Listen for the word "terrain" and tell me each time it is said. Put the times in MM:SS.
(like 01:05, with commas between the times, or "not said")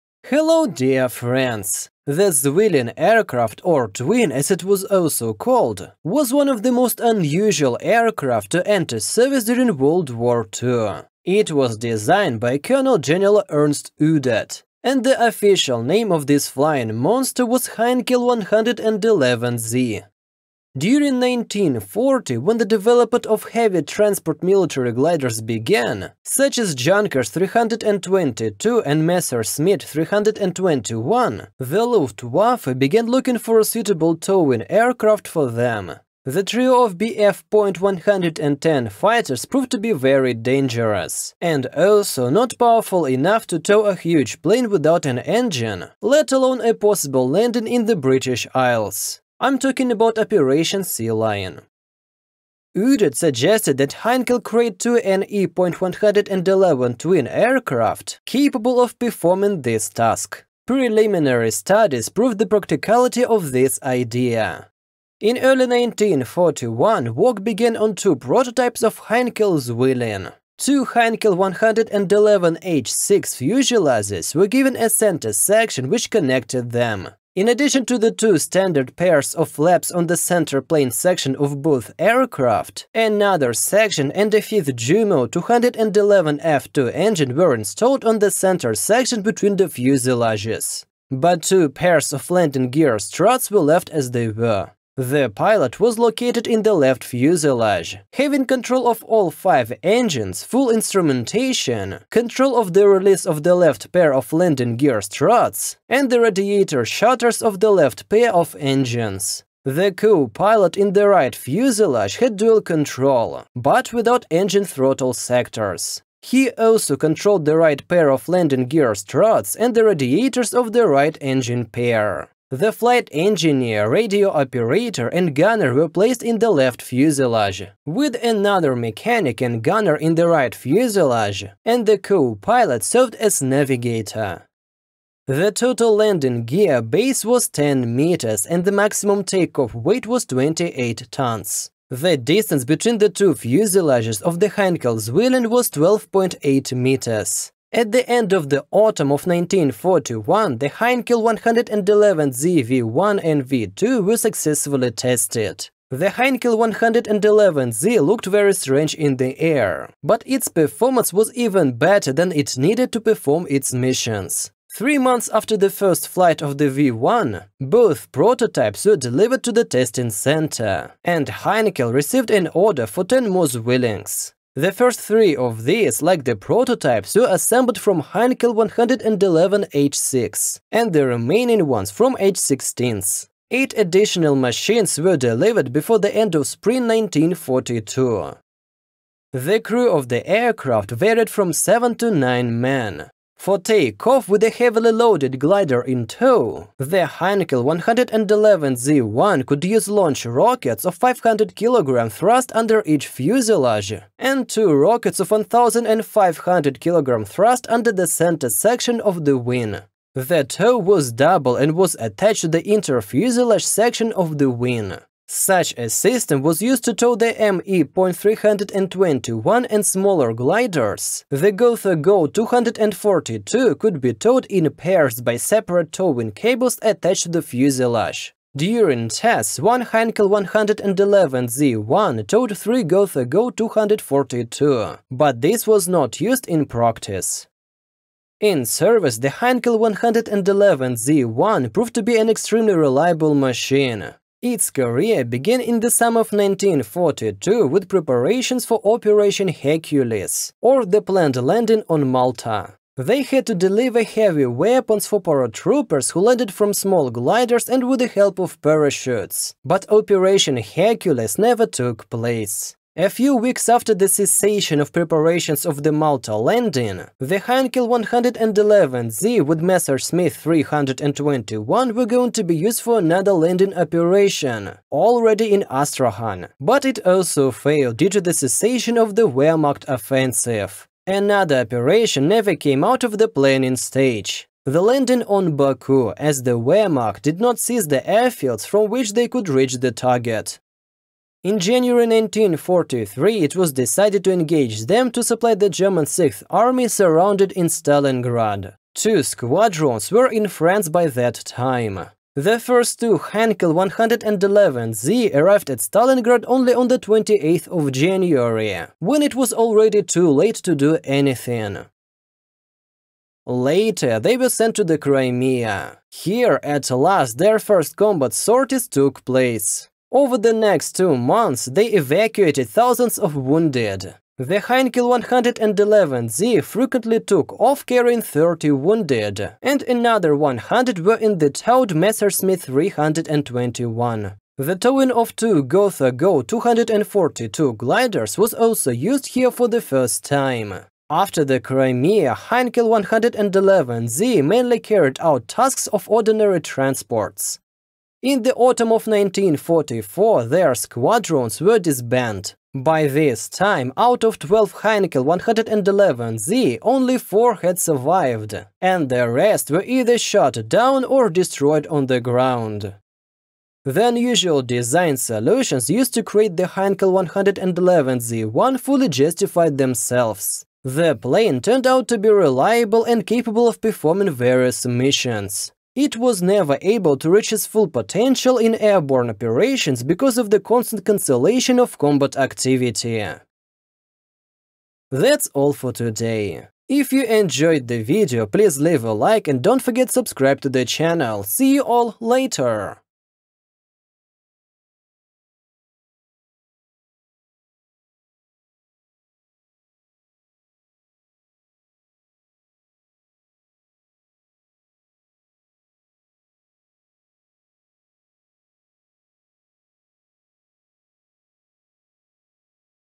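not said.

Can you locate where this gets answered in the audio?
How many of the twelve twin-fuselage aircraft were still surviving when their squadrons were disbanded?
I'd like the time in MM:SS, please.
05:56.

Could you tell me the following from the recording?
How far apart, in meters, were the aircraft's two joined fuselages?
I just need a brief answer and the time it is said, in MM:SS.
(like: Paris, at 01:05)
12.8, at 02:25.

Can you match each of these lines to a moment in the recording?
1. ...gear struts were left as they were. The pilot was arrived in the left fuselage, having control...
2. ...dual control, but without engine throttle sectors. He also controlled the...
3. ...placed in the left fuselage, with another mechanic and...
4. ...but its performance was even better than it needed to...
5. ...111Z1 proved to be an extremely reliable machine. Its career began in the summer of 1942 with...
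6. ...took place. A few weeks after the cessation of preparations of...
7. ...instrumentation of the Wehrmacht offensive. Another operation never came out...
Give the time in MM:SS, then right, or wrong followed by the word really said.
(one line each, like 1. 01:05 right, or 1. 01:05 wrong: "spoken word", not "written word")
1. 01:32 wrong: "located", not "arrived"
2. 01:52 right
3. 02:05 right
4. 02:40 right
5. 03:59 right
6. 04:21 right
7. 04:38 wrong: "cessation", not "instrumentation".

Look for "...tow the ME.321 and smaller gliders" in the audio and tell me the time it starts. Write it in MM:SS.
03:36.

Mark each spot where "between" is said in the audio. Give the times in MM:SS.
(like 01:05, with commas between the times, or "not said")
01:29, 02:22.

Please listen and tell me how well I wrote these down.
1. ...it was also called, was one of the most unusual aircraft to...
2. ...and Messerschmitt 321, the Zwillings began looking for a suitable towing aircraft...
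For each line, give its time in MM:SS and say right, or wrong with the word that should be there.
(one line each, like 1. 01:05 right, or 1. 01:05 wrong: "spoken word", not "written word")
1. 00:04 right
2. 00:28 wrong: "Luftwaffe", not "Zwillings".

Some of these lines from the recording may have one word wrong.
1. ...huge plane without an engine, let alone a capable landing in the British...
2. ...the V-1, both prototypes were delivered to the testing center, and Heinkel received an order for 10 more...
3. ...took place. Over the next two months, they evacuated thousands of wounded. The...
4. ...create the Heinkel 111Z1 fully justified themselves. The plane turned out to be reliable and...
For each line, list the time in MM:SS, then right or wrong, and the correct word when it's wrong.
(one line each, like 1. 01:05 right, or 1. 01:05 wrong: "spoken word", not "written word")
1. 00:43 wrong: "possible", not "capable"
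2. 02:46 right
3. 05:18 right
4. 06:06 right.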